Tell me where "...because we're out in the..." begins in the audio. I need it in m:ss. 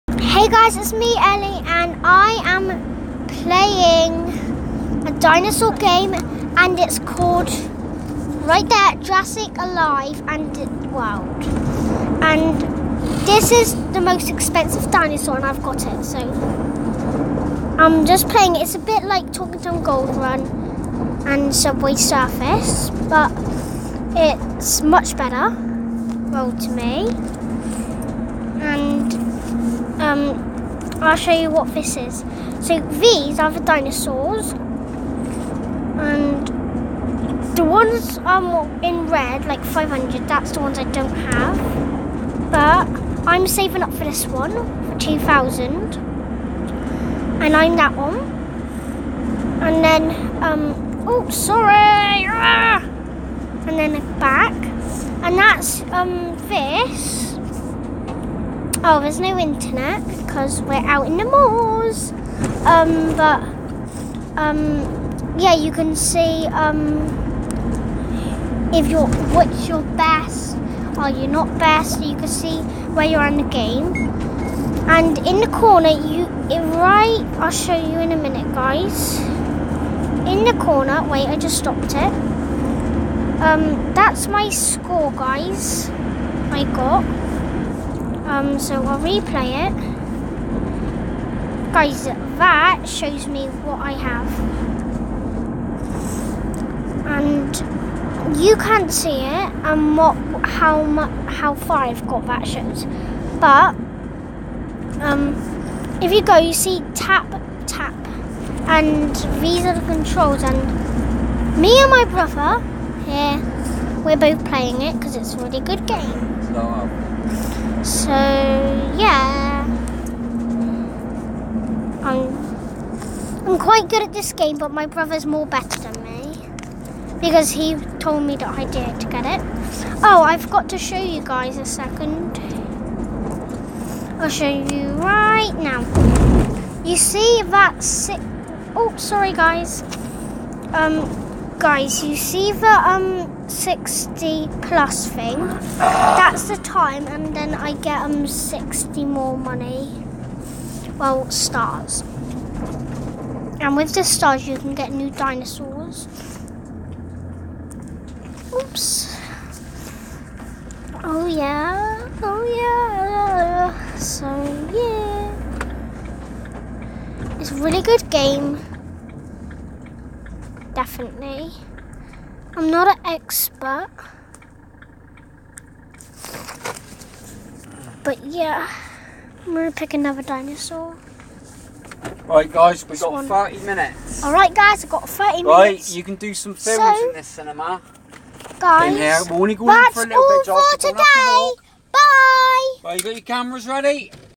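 1:00.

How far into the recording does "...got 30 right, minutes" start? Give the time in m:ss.
3:04.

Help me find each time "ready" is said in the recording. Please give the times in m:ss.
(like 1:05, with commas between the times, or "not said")
3:13.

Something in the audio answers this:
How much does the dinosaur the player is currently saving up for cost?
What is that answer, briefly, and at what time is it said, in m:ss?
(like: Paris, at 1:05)
2,000, at 0:44.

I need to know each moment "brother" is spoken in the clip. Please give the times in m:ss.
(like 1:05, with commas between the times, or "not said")
1:52, 2:04.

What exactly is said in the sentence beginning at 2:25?
That's the time, and then I get um 60 more money.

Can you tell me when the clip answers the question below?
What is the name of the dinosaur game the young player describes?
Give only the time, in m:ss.
0:09.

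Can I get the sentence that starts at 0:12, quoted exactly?
And this is the most expensive dinosaur and I've got it.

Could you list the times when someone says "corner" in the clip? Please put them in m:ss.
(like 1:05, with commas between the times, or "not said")
1:15, 1:20.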